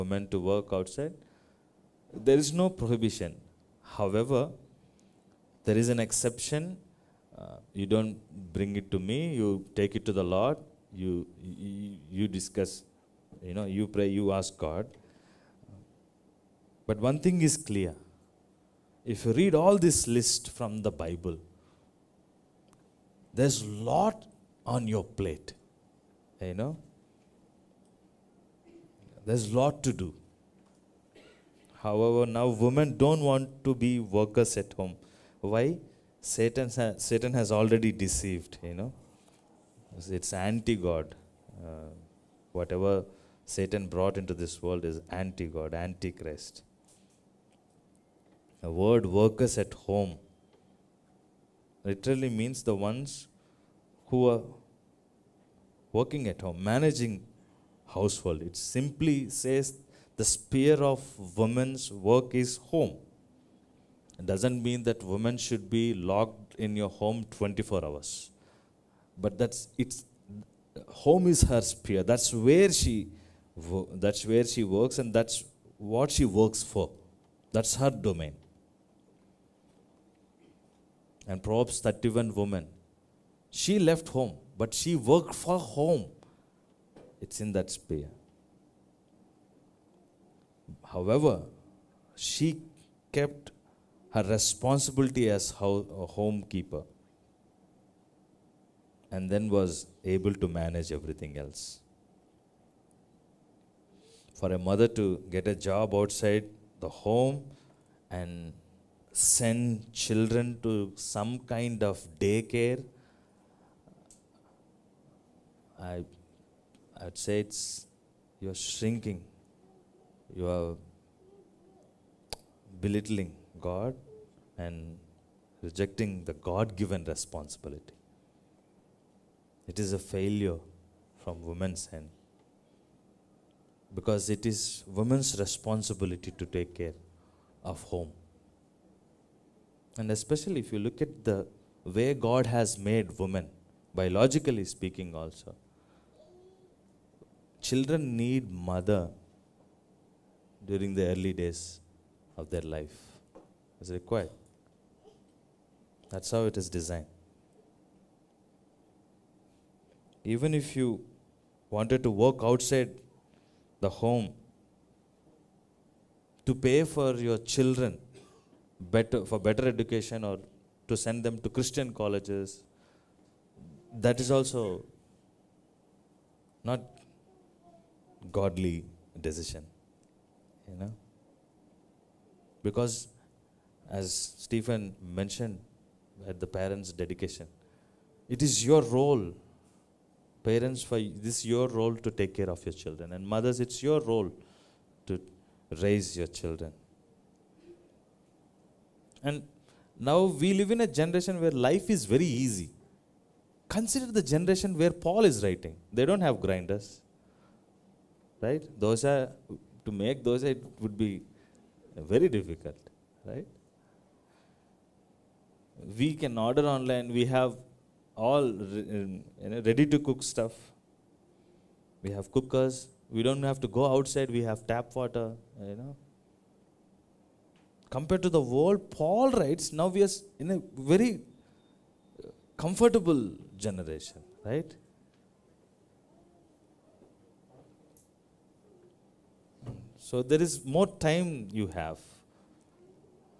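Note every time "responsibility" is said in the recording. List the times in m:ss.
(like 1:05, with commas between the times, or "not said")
1:34, 2:07, 2:15.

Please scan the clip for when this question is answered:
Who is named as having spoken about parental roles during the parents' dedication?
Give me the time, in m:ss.
3:04.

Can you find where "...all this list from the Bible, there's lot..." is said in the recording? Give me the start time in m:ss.
0:19.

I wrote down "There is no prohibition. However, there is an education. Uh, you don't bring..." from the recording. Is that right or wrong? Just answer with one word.
wrong.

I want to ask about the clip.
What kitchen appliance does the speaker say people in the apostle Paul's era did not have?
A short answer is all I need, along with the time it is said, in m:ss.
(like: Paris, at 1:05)
Grinders, at 3:26.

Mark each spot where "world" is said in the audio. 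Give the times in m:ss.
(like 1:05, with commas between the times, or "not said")
0:44, 3:48.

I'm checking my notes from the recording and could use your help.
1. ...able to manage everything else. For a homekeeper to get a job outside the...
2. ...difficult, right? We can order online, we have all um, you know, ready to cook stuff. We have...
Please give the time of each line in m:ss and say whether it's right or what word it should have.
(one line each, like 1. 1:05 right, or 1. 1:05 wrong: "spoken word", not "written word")
1. 1:40 wrong: "mother", not "homekeeper"
2. 3:32 right.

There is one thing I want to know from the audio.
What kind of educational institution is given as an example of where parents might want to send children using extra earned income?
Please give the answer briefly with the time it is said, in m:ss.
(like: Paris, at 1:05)
Christian colleges, at 2:51.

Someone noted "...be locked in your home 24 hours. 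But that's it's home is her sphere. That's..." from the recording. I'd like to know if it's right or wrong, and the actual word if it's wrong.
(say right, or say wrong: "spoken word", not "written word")
right.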